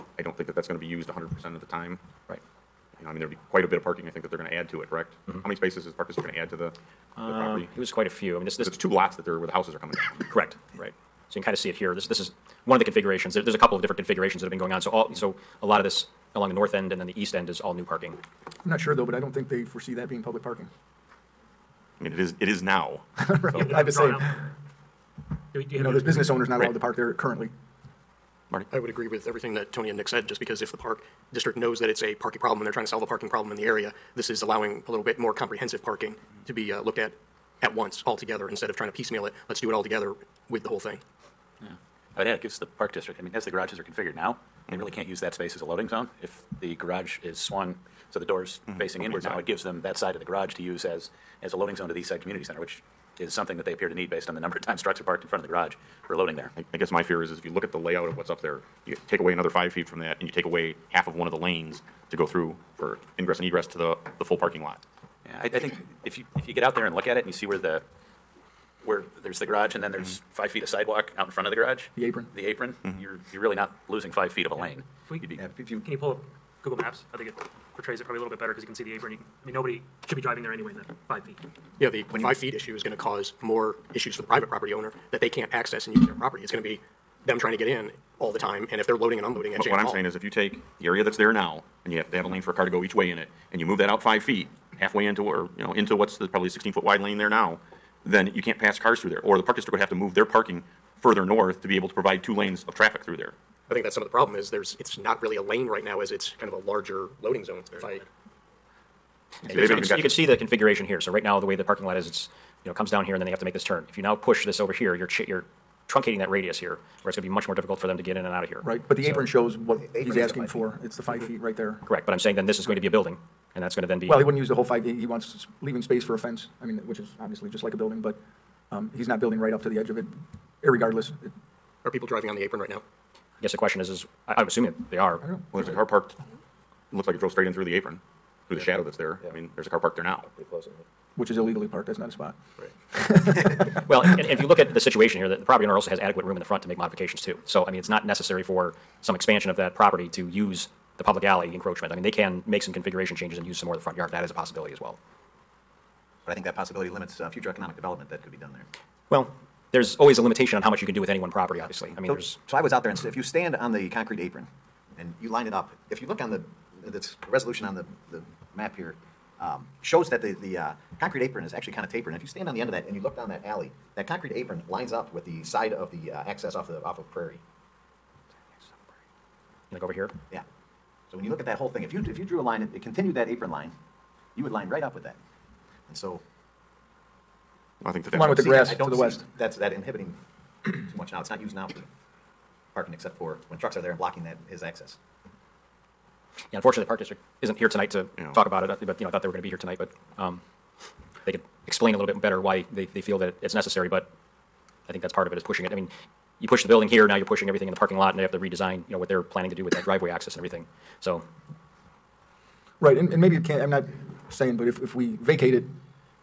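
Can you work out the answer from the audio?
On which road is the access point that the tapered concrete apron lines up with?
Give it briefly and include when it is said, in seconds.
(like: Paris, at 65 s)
Prairie, at 177 s.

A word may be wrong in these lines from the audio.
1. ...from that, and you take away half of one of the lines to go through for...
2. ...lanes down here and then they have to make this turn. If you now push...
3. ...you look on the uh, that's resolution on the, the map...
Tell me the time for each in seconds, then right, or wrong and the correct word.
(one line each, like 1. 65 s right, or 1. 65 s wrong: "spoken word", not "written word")
1. 59 s wrong: "lanes", not "lines"
2. 112 s wrong: "comes", not "lanes"
3. 166 s right.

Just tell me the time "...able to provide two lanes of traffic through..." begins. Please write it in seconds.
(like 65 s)
101 s.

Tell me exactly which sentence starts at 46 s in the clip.
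If the garage is swung, so the door's mm-hmm.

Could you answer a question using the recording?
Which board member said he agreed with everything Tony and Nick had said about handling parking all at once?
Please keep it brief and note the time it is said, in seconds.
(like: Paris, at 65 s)
Marty, at 28 s.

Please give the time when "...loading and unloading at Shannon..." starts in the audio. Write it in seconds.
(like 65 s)
88 s.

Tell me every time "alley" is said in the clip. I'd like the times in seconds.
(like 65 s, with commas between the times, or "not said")
151 s, 173 s.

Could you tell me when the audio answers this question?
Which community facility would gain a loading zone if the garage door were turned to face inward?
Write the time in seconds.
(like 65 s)
51 s.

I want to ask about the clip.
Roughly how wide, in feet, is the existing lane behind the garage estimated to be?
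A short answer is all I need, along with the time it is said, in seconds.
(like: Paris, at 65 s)
16 feet, at 96 s.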